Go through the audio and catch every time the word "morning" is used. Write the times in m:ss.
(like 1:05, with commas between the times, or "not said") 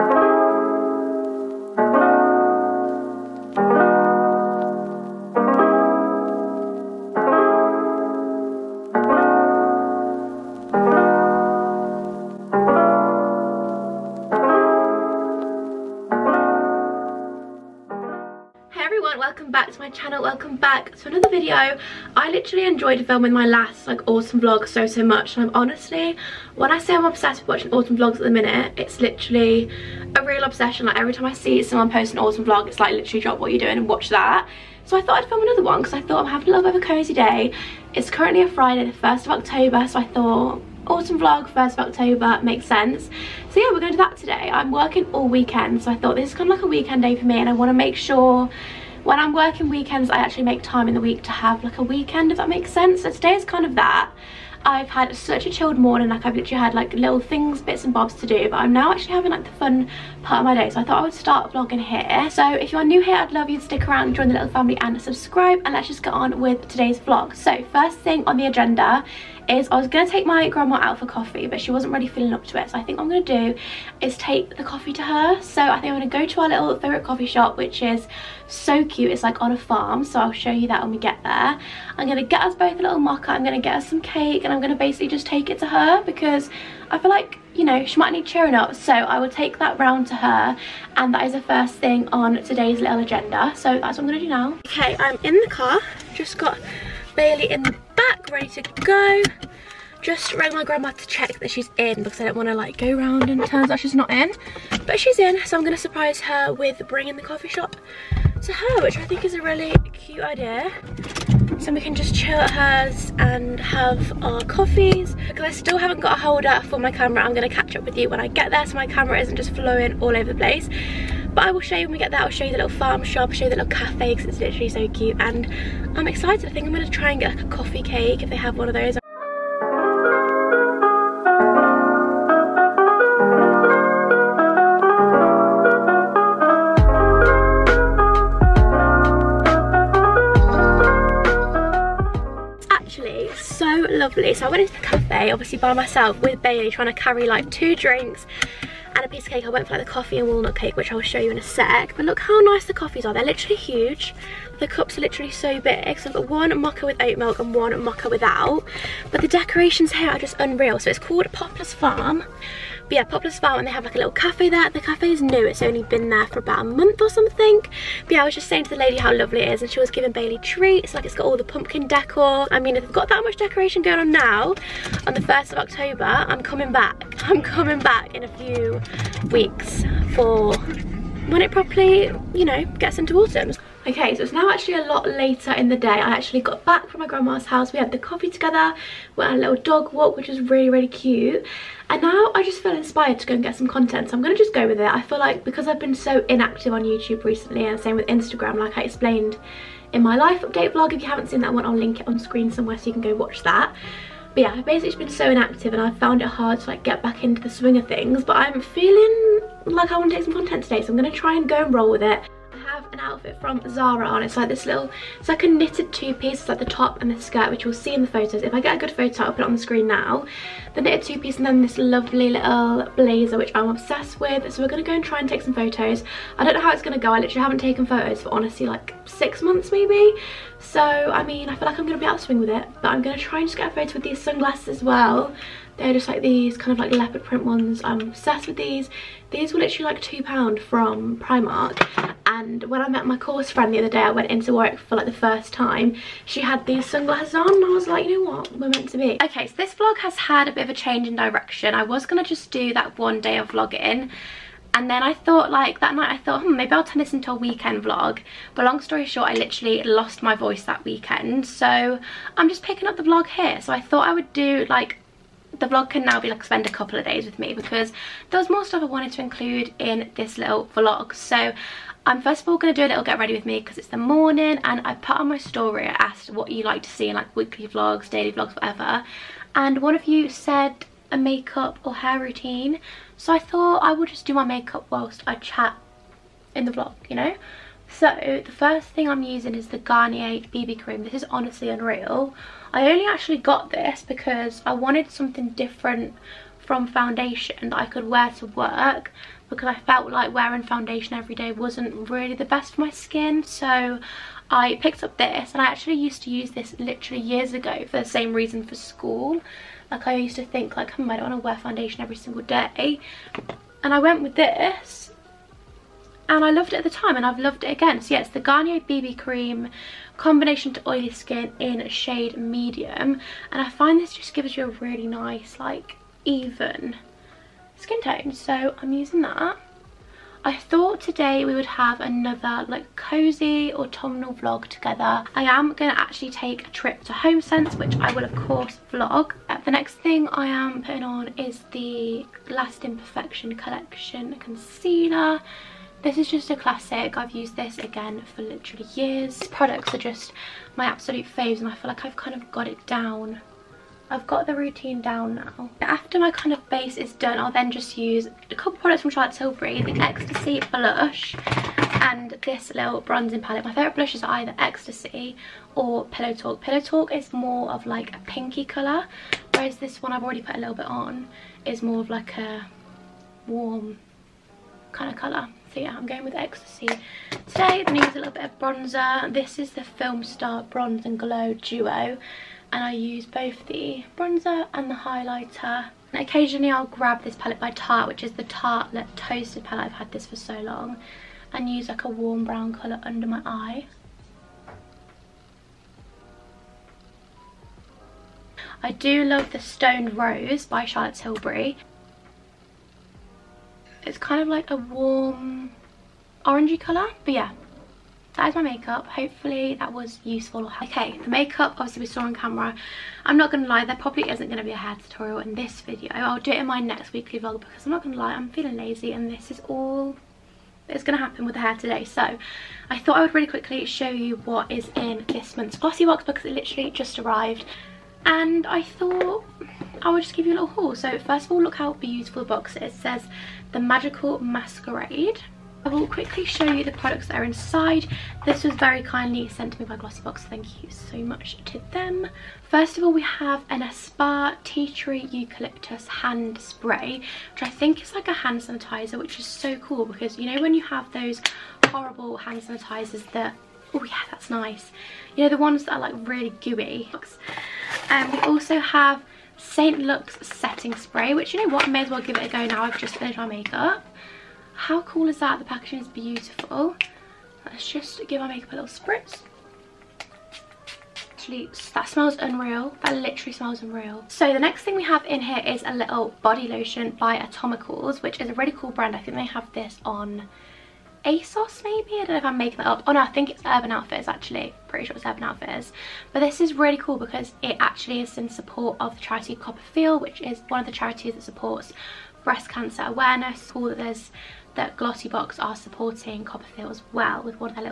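0:55, 4:33.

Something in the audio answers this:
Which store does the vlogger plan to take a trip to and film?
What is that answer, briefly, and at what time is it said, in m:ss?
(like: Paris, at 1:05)
HomeSense, at 5:37.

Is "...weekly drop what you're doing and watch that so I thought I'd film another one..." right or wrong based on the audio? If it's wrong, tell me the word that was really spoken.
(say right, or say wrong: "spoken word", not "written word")
wrong: "literally", not "weekly".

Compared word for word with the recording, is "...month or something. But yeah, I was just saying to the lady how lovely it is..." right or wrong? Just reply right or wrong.
right.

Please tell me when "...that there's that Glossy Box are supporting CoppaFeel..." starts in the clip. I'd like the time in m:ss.
8:13.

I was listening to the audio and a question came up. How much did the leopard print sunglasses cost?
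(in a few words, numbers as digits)
£2.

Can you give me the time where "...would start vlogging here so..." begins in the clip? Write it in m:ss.
1:01.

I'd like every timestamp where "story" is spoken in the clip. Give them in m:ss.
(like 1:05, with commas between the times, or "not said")
4:18, 4:35.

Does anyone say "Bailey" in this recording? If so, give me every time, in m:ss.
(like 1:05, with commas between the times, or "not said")
1:37, 2:26, 2:50.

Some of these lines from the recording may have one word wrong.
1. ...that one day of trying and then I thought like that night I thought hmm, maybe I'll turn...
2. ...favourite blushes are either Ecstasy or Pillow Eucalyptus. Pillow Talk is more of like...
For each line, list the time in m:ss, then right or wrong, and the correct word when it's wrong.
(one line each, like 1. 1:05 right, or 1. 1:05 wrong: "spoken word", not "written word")
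1. 4:12 wrong: "vlogging", not "trying"
2. 6:03 wrong: "Talk", not "Eucalyptus".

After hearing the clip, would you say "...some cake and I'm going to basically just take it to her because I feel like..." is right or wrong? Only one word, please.
right.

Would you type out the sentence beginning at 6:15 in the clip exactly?
So yeah, I'm going with Ecstasy today.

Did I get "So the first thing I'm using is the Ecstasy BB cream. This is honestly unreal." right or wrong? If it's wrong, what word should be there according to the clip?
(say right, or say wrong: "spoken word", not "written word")
wrong: "Garnier", not "Ecstasy".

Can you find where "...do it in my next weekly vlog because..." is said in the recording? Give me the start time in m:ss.
6:56.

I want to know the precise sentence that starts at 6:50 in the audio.
Okay, the makeup obviously we saw on camera.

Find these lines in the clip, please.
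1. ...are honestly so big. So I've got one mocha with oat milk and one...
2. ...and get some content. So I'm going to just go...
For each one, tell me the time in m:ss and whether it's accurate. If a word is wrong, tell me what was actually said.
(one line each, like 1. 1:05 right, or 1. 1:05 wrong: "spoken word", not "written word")
1. 2:34 wrong: "literally", not "honestly"
2. 3:13 right.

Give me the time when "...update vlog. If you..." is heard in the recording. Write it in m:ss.
3:20.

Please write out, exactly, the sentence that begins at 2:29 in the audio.
I went for like the coffee and walnut cake, which I'll show you in a sec.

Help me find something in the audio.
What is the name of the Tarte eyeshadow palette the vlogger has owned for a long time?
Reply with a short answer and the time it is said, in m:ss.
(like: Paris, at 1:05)
Tartelette Toasted, at 6:28.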